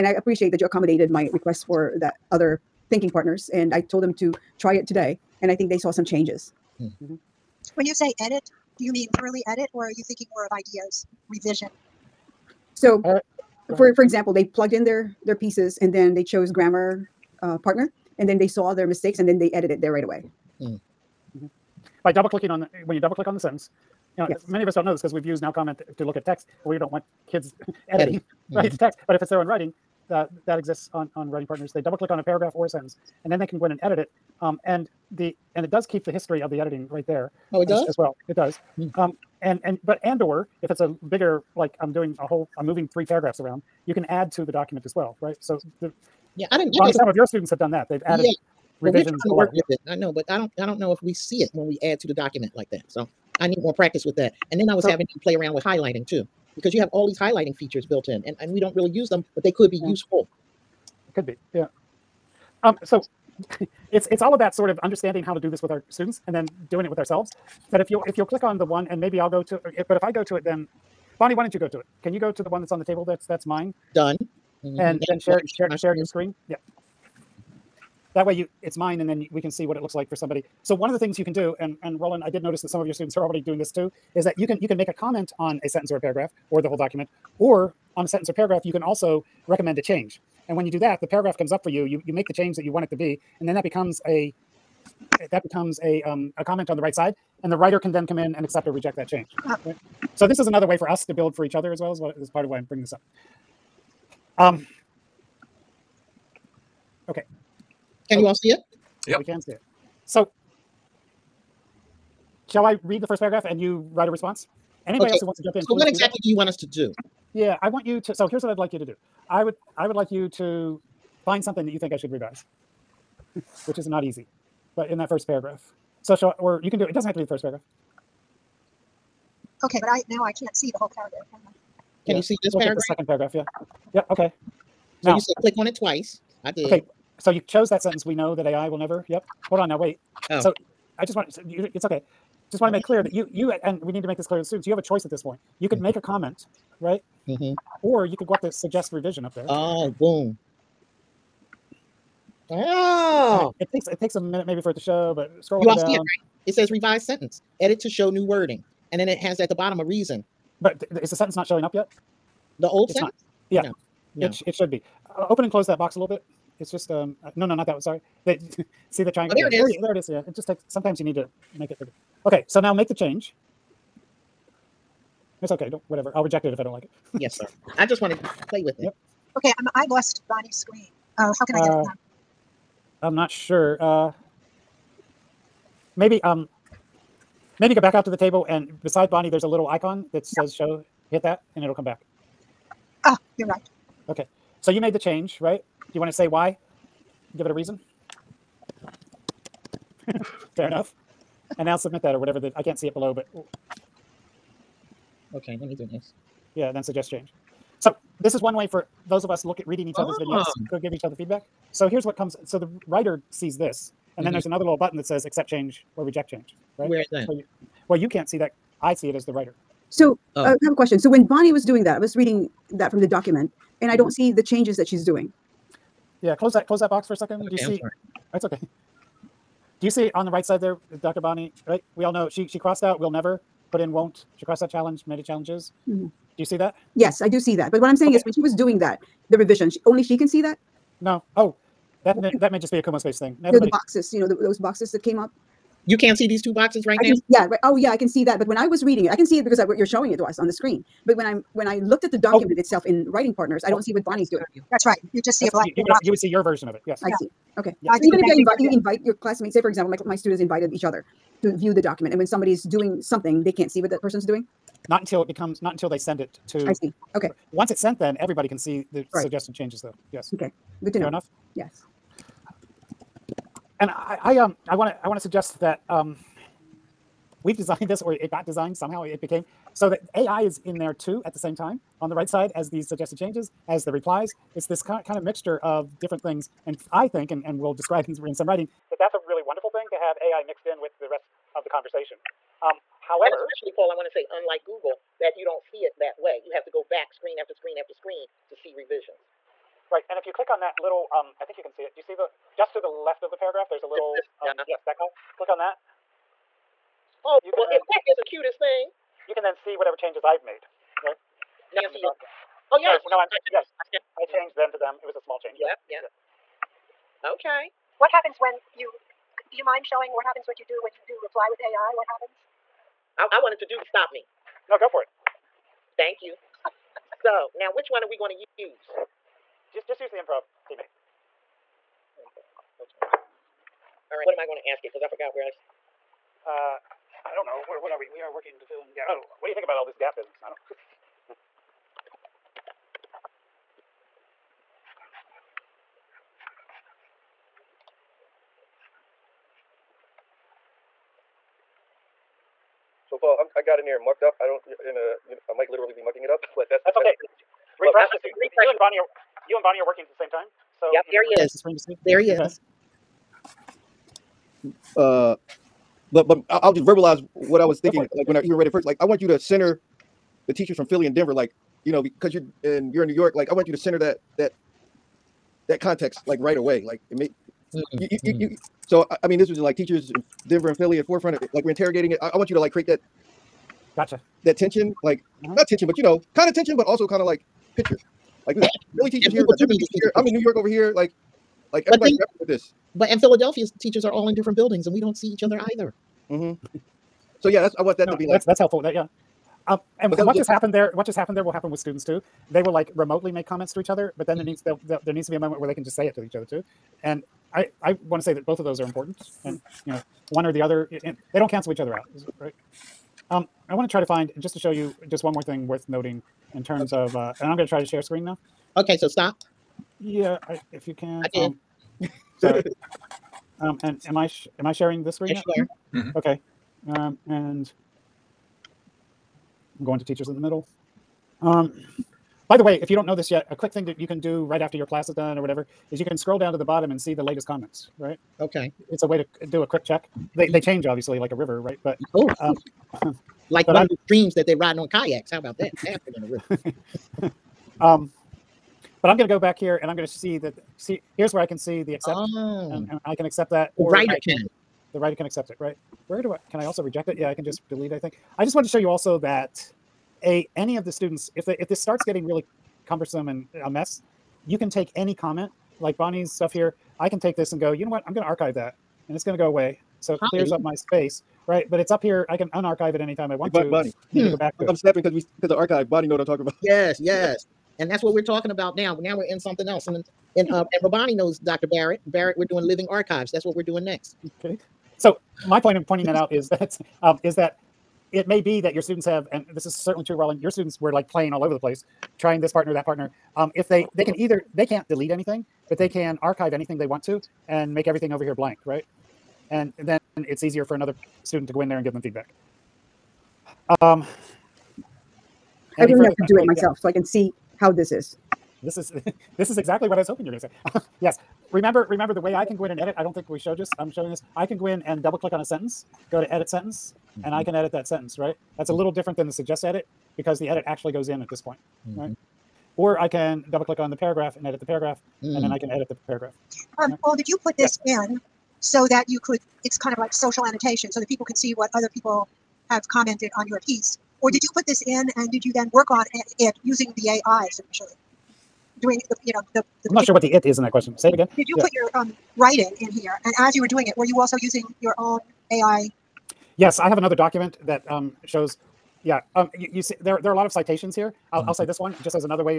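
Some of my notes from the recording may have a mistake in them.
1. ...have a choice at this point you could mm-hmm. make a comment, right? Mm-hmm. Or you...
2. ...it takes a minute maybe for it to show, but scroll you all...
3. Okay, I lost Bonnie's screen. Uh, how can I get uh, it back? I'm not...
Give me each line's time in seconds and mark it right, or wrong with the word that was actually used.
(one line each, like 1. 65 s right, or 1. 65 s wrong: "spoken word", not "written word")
1. 144 s right
2. 153 s right
3. 179 s right.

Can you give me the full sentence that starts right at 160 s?
But th- th- is the sentence not showing up yet?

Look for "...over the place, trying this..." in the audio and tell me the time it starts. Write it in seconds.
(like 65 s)
491 s.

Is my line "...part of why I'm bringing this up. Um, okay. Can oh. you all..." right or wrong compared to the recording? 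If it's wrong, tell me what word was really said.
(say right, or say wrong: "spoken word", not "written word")
right.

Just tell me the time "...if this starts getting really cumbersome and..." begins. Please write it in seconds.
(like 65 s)
461 s.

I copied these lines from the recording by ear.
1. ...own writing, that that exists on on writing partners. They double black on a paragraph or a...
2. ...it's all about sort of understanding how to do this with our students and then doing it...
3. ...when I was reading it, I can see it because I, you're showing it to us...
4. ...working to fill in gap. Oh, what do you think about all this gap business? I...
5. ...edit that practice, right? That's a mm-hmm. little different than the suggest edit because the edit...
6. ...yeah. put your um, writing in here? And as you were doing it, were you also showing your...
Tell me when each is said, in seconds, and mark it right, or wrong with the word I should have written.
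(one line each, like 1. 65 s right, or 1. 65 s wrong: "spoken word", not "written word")
1. 29 s wrong: "click", not "black"
2. 64 s right
3. 248 s right
4. 338 s right
5. 517 s wrong: "sentence", not "practice"
6. 541 s wrong: "using", not "showing".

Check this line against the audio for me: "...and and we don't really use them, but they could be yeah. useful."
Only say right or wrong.
right.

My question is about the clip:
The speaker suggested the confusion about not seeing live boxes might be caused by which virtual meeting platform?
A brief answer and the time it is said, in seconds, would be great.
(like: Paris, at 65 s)
Kumospace, at 242 s.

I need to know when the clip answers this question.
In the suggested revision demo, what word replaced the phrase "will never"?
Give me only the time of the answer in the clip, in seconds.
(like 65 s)
233 s.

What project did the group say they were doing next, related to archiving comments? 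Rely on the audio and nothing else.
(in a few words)
living archives.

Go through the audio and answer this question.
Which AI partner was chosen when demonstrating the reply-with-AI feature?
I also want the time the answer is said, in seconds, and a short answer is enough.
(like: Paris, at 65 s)
improv teammate, at 330 s.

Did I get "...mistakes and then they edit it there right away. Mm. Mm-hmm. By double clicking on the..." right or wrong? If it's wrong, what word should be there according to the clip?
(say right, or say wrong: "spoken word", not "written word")
right.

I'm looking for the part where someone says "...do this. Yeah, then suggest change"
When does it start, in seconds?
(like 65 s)
205 s.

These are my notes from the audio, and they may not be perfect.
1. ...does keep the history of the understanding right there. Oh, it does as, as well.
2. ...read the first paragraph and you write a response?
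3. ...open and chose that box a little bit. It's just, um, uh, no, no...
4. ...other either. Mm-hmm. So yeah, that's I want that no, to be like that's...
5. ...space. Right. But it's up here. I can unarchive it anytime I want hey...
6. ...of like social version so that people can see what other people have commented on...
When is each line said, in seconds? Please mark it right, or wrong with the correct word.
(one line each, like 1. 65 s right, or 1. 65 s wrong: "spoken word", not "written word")
1. 35 s wrong: "editing", not "understanding"
2. 112 s right
3. 165 s wrong: "close", not "chose"
4. 395 s right
5. 470 s right
6. 529 s wrong: "annotation", not "version".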